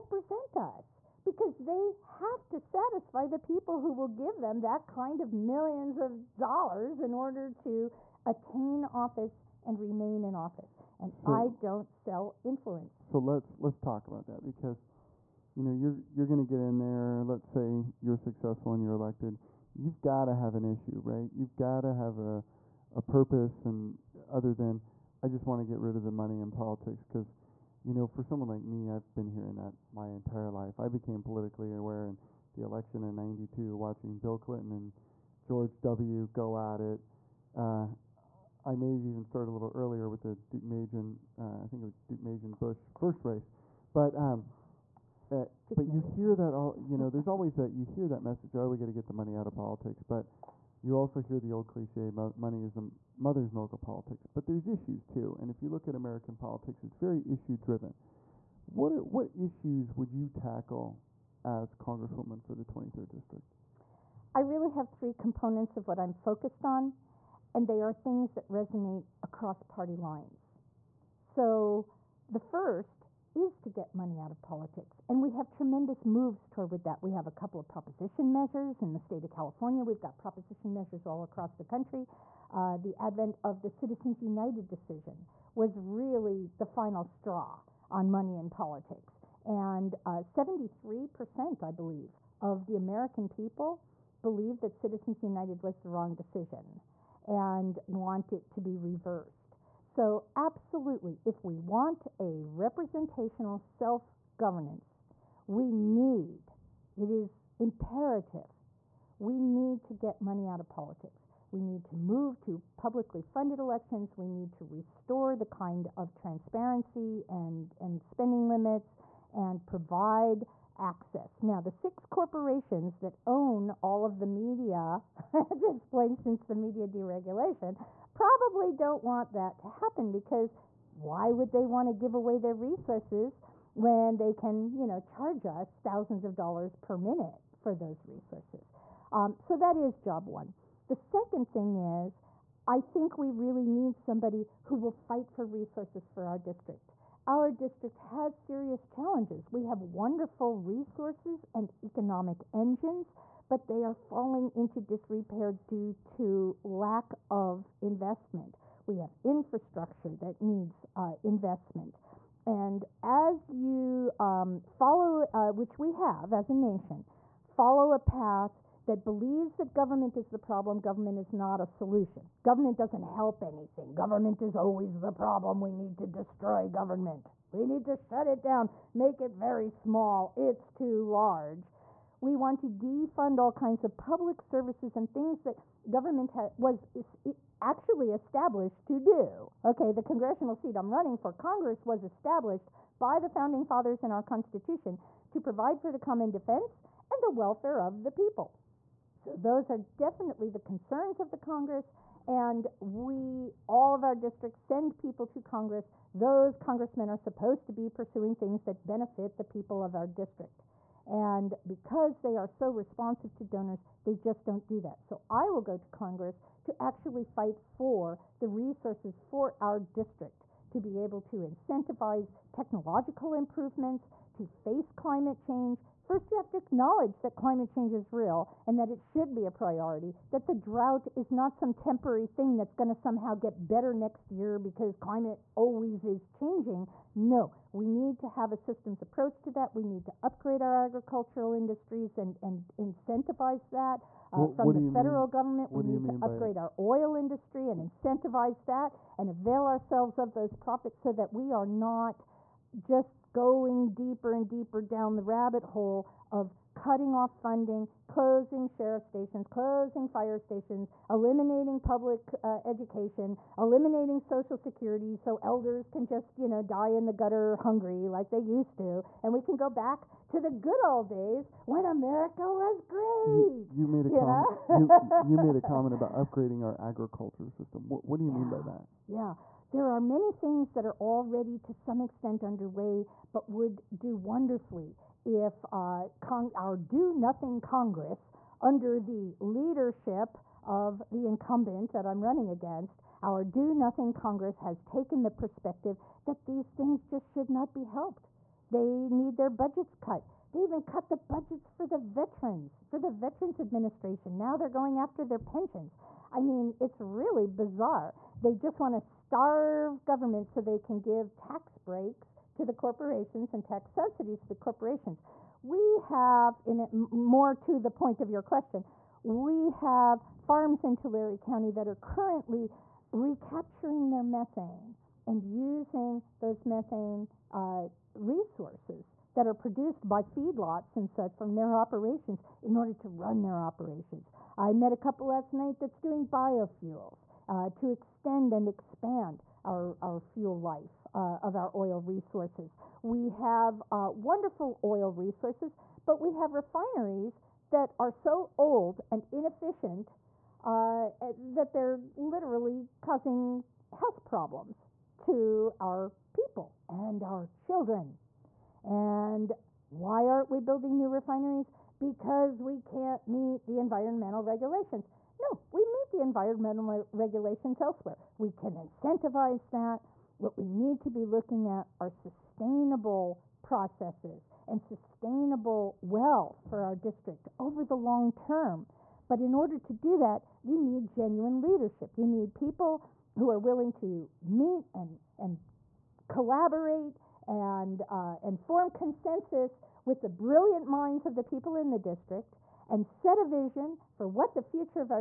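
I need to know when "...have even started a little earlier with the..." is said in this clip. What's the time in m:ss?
0:38.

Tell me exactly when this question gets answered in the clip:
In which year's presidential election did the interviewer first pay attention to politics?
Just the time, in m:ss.
0:33.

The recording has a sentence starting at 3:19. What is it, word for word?
So those are definitely the concerns of the Congress, and we, all of our districts, send people to Congress.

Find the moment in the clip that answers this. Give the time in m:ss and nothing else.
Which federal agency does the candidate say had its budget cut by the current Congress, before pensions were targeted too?
5:03.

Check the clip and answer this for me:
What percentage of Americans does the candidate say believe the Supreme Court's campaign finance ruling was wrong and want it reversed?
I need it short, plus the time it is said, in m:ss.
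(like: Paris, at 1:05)
73%, at 1:30.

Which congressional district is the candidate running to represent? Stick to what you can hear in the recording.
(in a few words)
23rd district.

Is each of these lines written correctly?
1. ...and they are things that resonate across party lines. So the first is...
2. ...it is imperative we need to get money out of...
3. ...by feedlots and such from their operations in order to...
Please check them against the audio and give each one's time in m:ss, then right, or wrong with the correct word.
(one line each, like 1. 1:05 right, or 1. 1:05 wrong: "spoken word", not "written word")
1. 1:07 right
2. 1:46 right
3. 5:30 right.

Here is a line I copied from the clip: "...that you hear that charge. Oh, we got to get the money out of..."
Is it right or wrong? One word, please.
wrong.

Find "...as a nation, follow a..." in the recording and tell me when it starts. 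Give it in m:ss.
2:46.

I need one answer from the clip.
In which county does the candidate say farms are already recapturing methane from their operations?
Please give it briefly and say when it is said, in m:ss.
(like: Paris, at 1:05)
Tulare County, at 5:20.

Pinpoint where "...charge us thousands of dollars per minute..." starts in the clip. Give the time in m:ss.
2:14.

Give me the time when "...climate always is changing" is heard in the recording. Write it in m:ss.
3:54.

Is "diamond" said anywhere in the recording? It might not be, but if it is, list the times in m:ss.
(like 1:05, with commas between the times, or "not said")
not said.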